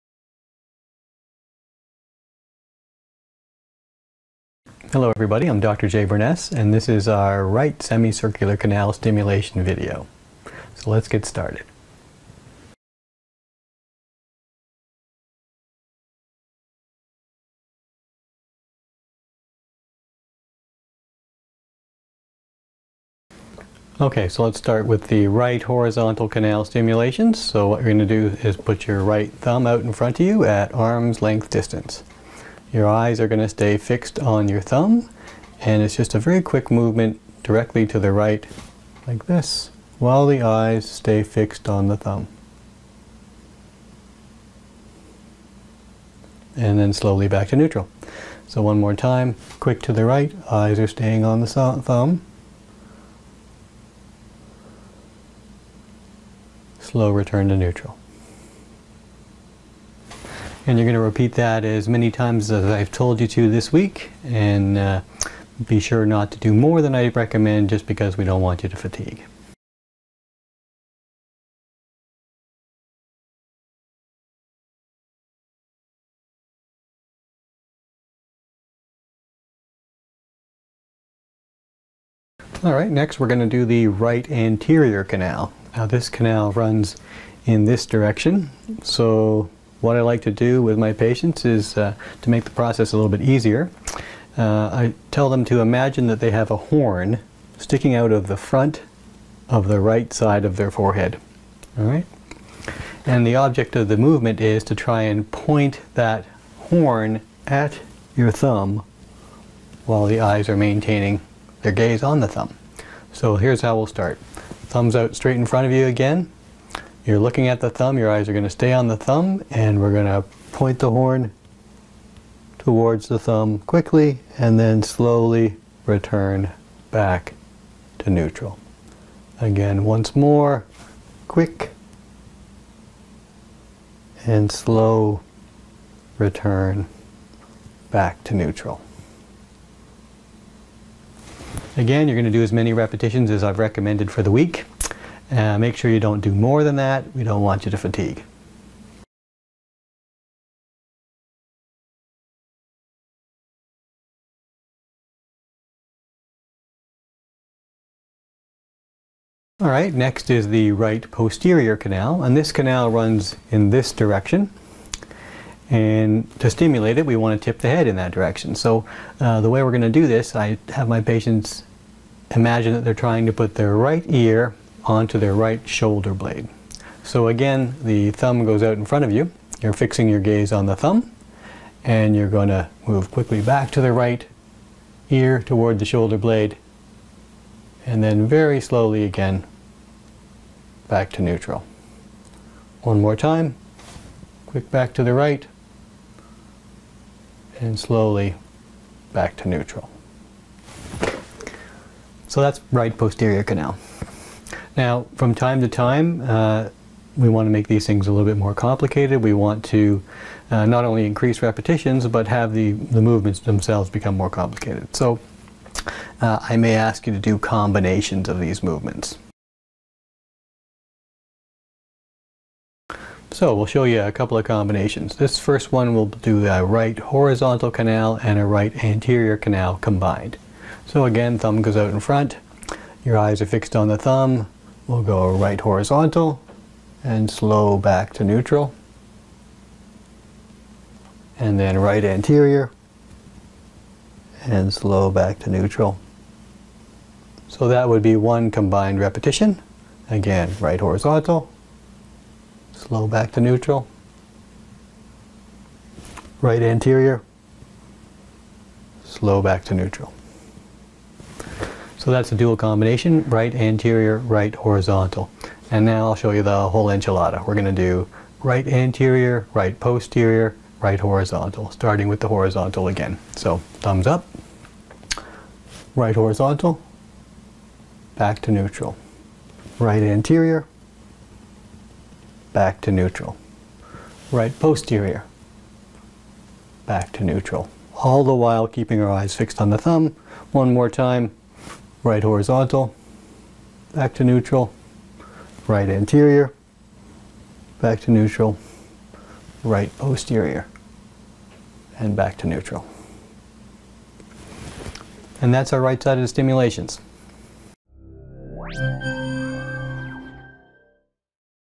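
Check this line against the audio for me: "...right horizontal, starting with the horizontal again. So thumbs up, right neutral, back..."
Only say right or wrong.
wrong.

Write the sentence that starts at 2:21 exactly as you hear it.
Again, you're going to do as many repetitions as I've recommended for the week.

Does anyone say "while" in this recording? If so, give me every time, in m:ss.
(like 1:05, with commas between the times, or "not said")
0:39, 1:49, 4:48.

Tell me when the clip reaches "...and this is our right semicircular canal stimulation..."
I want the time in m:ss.
0:06.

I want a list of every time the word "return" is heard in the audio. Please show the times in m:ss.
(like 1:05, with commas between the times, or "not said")
0:57, 2:05, 2:16.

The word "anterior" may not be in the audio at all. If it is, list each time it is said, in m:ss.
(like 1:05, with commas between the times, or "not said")
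1:24, 3:48, 4:02, 4:16, 4:23, 4:28, 4:40, 4:55.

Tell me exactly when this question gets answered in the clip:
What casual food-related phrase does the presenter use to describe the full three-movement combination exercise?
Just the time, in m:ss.
4:26.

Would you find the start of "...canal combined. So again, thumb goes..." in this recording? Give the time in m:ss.
3:49.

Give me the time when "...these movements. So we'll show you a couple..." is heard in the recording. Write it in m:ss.
3:38.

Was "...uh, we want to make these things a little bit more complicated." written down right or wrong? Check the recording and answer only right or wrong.
right.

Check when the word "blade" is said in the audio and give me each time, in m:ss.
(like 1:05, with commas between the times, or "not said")
2:56, 3:06.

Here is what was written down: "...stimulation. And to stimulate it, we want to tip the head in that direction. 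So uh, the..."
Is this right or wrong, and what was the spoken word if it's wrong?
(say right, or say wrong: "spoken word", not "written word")
wrong: "direction", not "stimulation".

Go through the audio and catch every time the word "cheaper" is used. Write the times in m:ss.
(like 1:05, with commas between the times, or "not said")
not said.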